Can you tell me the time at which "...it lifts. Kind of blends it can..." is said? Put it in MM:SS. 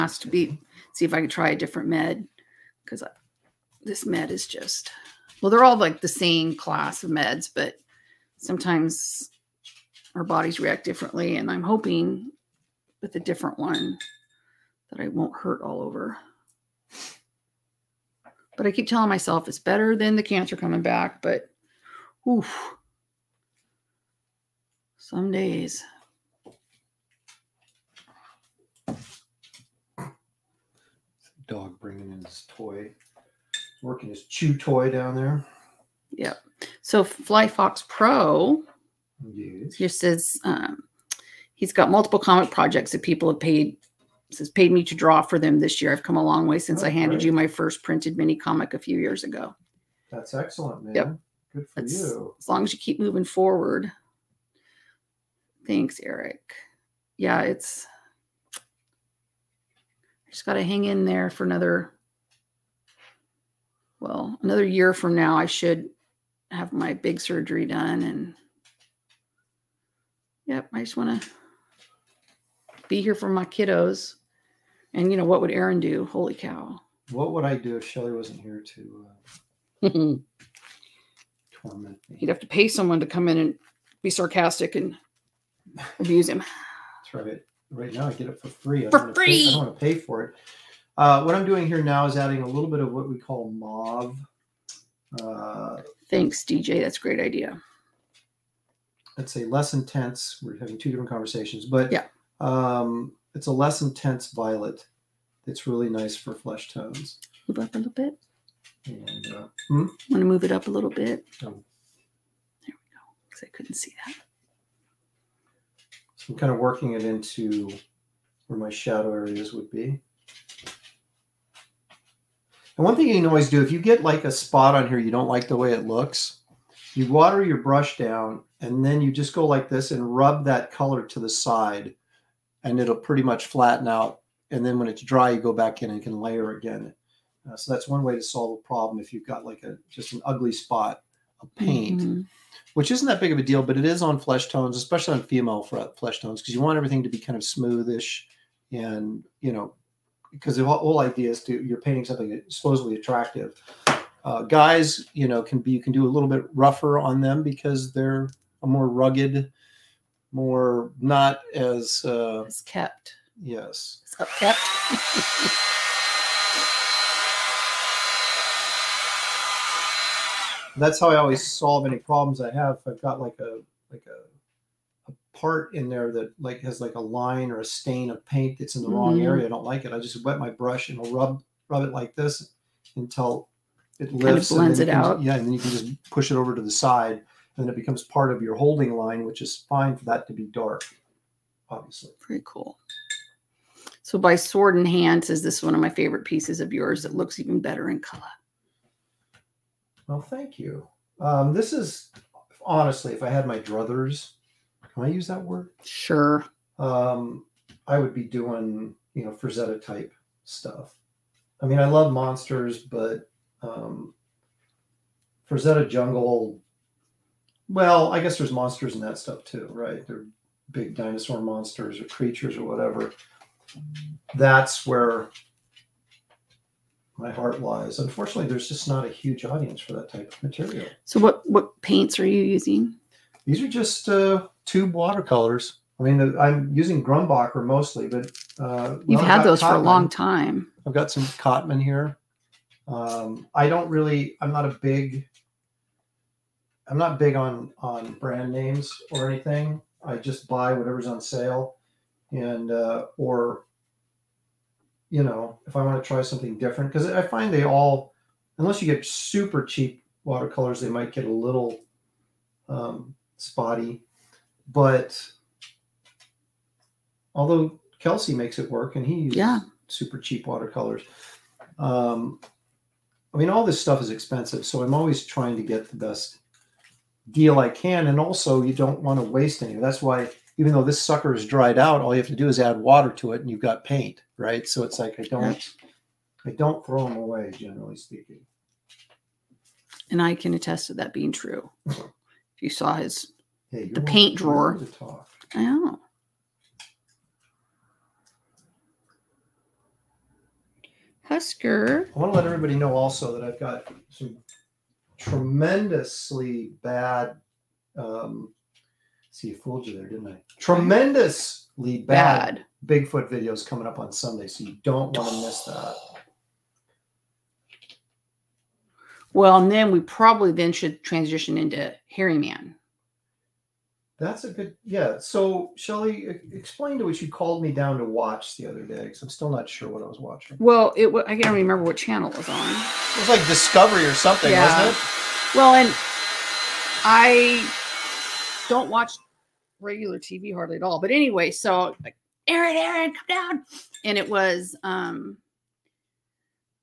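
03:03.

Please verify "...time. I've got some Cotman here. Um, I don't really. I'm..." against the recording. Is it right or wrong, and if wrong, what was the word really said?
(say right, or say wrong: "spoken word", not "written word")
right.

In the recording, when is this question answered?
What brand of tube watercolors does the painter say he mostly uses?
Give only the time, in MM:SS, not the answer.
03:57.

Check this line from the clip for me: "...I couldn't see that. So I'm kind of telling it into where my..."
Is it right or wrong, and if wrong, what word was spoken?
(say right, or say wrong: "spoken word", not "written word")
wrong: "working", not "telling".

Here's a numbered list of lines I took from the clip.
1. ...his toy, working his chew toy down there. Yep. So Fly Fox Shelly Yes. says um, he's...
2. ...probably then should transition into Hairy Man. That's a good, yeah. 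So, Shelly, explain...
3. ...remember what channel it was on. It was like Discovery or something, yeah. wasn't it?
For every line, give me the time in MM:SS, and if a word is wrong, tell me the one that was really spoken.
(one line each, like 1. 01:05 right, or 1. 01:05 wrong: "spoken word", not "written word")
1. 00:32 wrong: "Pro", not "Shelly"
2. 05:20 right
3. 05:31 right.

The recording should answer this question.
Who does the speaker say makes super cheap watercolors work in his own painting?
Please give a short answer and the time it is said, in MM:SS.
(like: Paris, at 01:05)
Kelsey, at 04:27.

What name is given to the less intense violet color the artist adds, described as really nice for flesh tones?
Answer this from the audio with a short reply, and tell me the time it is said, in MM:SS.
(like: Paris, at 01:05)
mauve, at 01:33.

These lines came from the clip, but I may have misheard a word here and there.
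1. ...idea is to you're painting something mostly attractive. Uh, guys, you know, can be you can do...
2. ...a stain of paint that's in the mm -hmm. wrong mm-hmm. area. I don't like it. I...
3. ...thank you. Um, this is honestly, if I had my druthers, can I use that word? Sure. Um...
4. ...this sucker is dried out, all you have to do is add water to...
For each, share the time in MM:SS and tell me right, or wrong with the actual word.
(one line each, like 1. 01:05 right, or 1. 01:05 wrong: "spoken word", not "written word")
1. 02:30 wrong: "supposedly", not "mostly"
2. 02:57 right
3. 03:20 right
4. 04:40 right.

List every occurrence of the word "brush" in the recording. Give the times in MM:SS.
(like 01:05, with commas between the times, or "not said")
02:07, 03:00.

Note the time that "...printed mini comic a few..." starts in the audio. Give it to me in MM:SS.
00:47.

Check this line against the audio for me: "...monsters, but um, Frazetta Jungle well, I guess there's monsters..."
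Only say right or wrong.
right.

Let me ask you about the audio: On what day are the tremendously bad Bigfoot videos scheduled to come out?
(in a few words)
Sunday.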